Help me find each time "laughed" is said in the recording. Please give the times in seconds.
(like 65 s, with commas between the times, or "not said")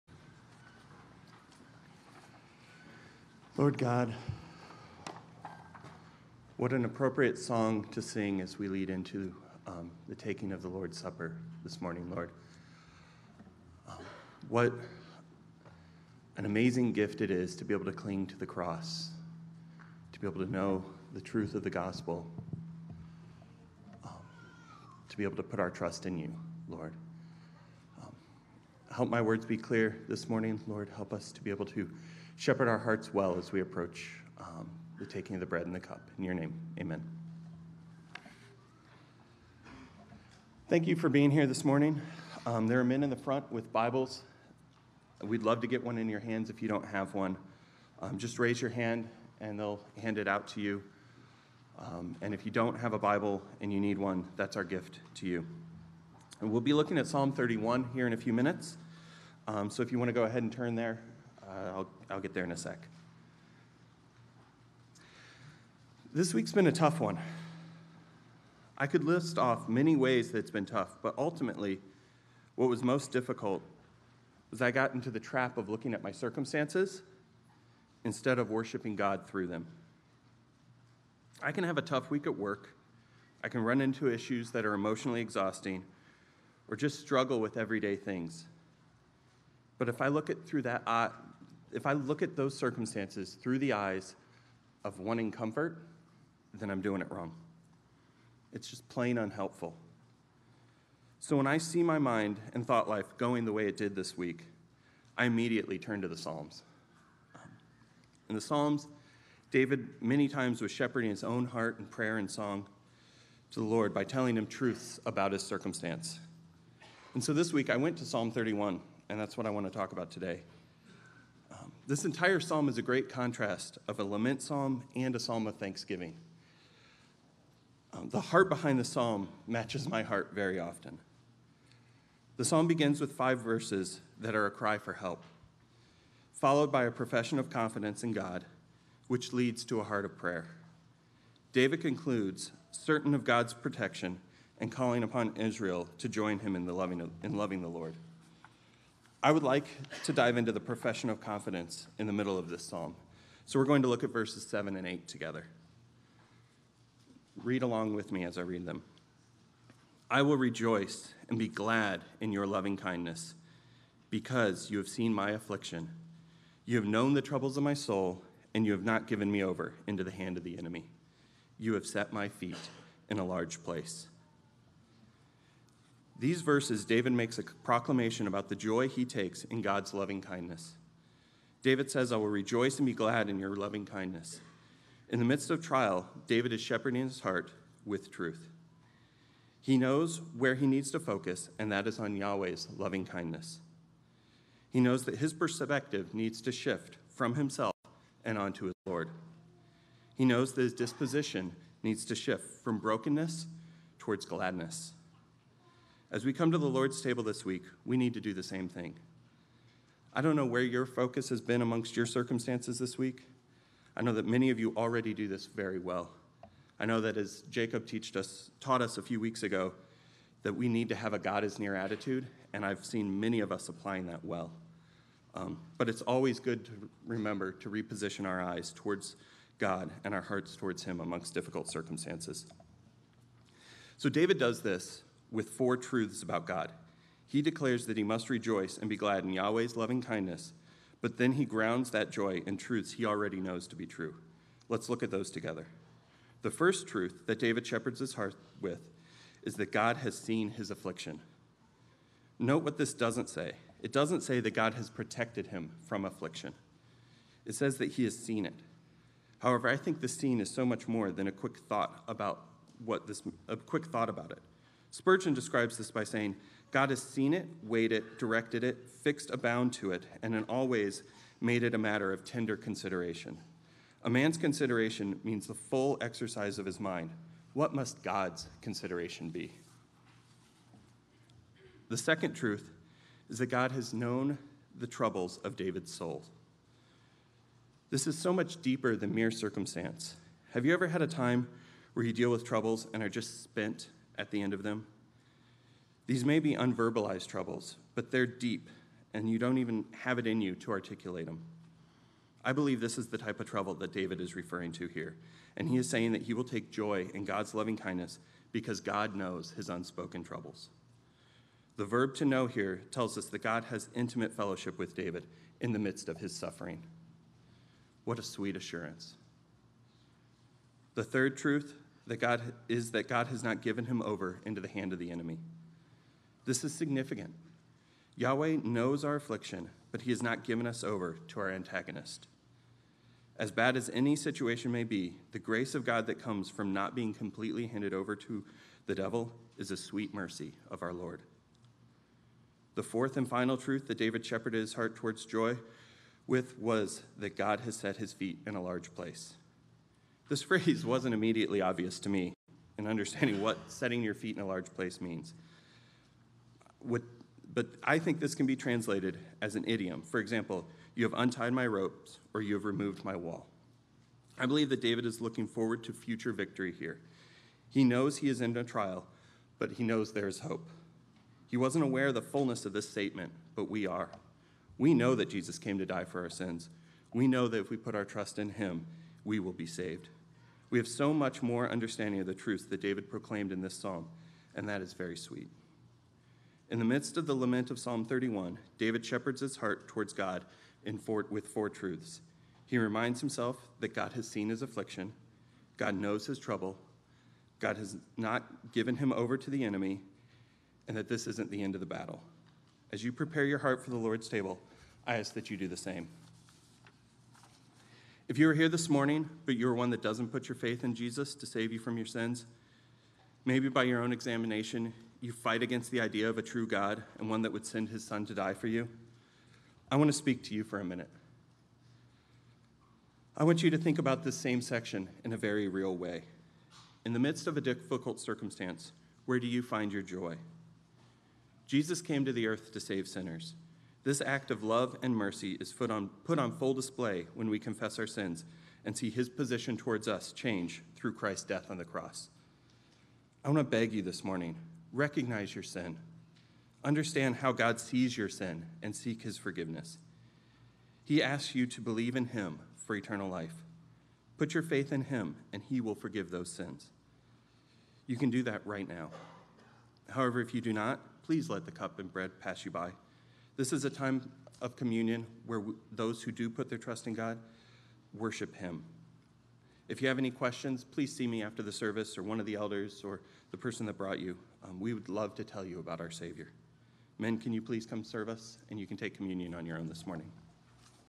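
not said.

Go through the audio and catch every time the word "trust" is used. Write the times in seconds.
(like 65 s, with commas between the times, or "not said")
25 s, 378 s, 466 s.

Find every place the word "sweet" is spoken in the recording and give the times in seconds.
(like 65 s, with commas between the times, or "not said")
318 s, 339 s, 385 s.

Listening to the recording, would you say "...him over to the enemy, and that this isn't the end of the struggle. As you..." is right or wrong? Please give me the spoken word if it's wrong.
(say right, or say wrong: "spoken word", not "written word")
wrong: "battle", not "struggle".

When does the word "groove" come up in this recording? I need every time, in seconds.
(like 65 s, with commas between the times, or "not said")
not said.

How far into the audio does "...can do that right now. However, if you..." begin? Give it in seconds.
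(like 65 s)
458 s.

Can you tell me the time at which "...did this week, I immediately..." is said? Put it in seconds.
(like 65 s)
103 s.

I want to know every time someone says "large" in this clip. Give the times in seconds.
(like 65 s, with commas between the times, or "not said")
173 s, 348 s, 354 s.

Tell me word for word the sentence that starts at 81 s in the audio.
I can have a tough week at work.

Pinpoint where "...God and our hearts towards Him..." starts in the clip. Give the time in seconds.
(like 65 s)
229 s.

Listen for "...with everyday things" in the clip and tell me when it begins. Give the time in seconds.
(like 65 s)
87 s.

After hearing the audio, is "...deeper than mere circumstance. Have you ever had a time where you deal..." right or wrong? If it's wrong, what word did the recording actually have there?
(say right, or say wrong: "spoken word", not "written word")
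right.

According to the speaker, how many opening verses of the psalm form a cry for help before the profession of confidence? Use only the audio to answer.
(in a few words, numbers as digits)
5.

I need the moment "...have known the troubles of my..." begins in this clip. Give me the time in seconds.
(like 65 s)
166 s.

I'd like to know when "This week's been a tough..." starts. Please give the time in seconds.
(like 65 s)
66 s.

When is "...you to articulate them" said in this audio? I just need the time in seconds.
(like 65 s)
300 s.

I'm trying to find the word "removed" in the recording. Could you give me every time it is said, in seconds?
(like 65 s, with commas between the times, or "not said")
362 s.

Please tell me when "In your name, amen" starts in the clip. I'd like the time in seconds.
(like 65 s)
36 s.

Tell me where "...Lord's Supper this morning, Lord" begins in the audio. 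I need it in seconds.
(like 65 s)
10 s.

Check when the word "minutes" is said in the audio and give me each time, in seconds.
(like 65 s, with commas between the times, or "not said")
58 s, 420 s.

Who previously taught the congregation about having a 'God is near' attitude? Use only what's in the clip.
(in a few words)
Jacob.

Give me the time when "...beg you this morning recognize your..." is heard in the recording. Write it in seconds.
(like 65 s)
443 s.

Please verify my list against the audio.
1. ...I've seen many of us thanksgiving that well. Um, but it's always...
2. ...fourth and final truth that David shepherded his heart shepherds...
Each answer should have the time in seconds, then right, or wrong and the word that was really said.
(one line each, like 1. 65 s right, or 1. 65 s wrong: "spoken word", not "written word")
1. 222 s wrong: "applying", not "thanksgiving"
2. 342 s wrong: "towards", not "shepherds".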